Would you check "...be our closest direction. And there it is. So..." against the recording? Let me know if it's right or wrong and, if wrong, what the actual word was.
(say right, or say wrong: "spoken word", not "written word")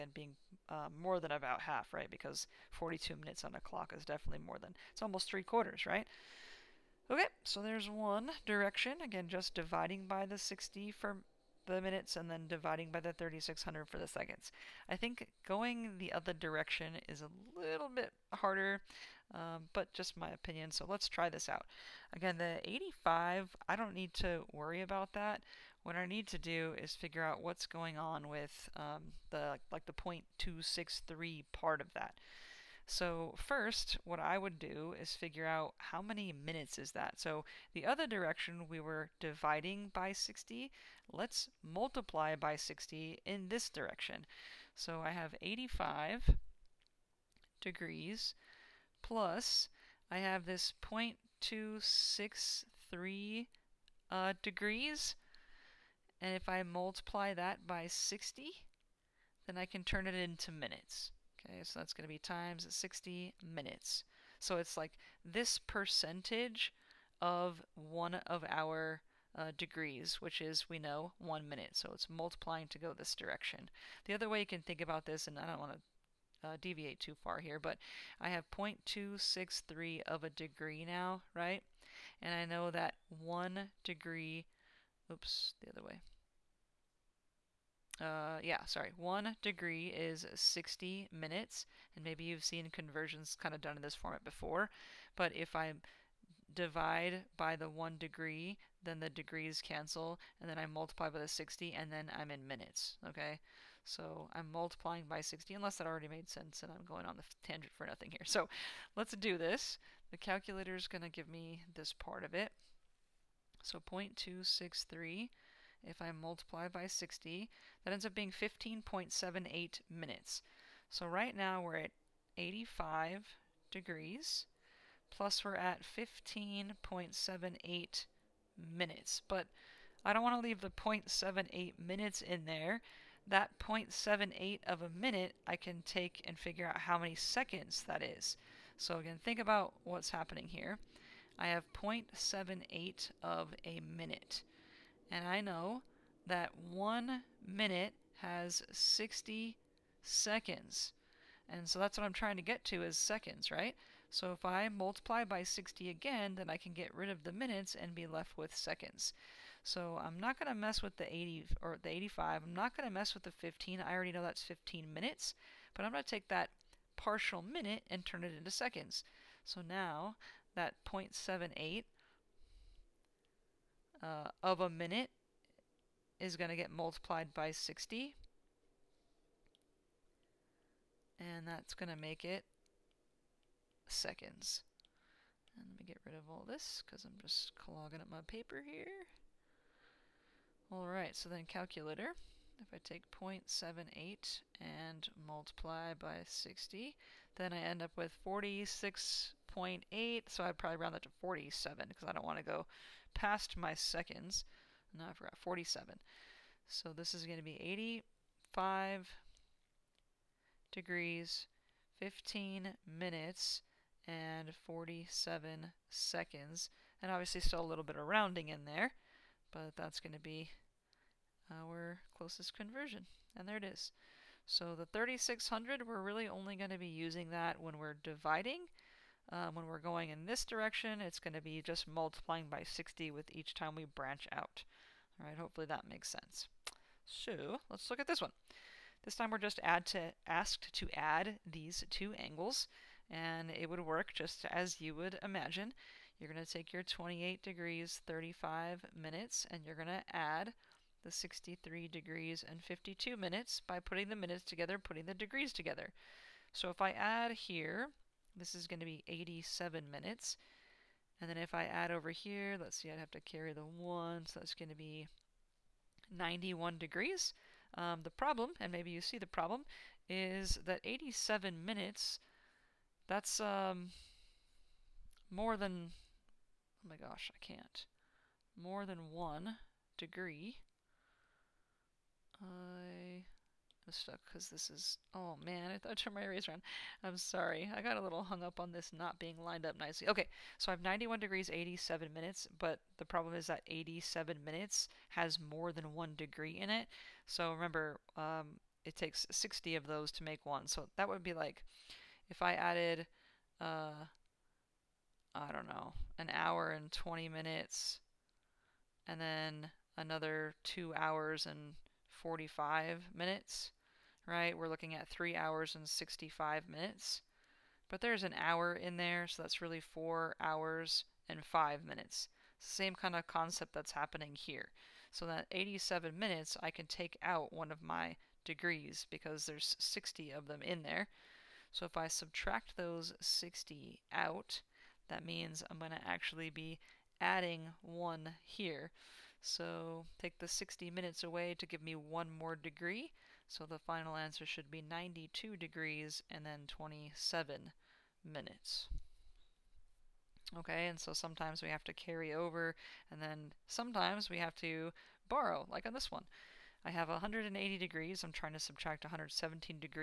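wrong: "conversion", not "direction".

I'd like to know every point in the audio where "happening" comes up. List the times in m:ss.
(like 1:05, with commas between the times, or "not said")
2:20, 5:23.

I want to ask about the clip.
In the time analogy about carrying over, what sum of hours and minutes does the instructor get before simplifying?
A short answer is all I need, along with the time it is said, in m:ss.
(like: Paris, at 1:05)
3 hours and 65 minutes, at 5:15.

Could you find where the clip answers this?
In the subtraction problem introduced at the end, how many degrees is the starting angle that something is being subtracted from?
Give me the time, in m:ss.
5:57.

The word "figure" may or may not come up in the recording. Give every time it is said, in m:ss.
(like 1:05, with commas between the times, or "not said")
0:26, 0:35, 2:16.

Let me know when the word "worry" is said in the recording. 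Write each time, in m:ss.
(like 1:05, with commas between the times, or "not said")
0:24.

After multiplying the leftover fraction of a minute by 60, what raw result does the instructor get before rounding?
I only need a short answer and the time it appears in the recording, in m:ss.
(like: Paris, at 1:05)
46.8, at 3:18.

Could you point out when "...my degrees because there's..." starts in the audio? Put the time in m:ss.
5:27.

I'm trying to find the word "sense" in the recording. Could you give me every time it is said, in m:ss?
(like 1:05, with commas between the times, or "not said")
1:46, 3:56.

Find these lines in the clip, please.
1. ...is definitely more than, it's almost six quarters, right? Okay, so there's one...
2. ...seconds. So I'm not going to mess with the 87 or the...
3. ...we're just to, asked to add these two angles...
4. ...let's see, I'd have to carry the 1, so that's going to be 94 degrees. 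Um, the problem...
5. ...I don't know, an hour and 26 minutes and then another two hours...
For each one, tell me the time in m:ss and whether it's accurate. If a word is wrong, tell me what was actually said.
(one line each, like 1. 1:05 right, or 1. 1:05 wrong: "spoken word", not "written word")
1. 0:03 wrong: "three", not "six"
2. 2:38 wrong: "80", not "87"
3. 3:59 right
4. 4:22 wrong: "91", not "94"
5. 5:05 wrong: "20", not "26".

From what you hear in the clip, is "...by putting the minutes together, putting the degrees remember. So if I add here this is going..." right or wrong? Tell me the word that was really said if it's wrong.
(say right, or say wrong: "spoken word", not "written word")
wrong: "together", not "remember".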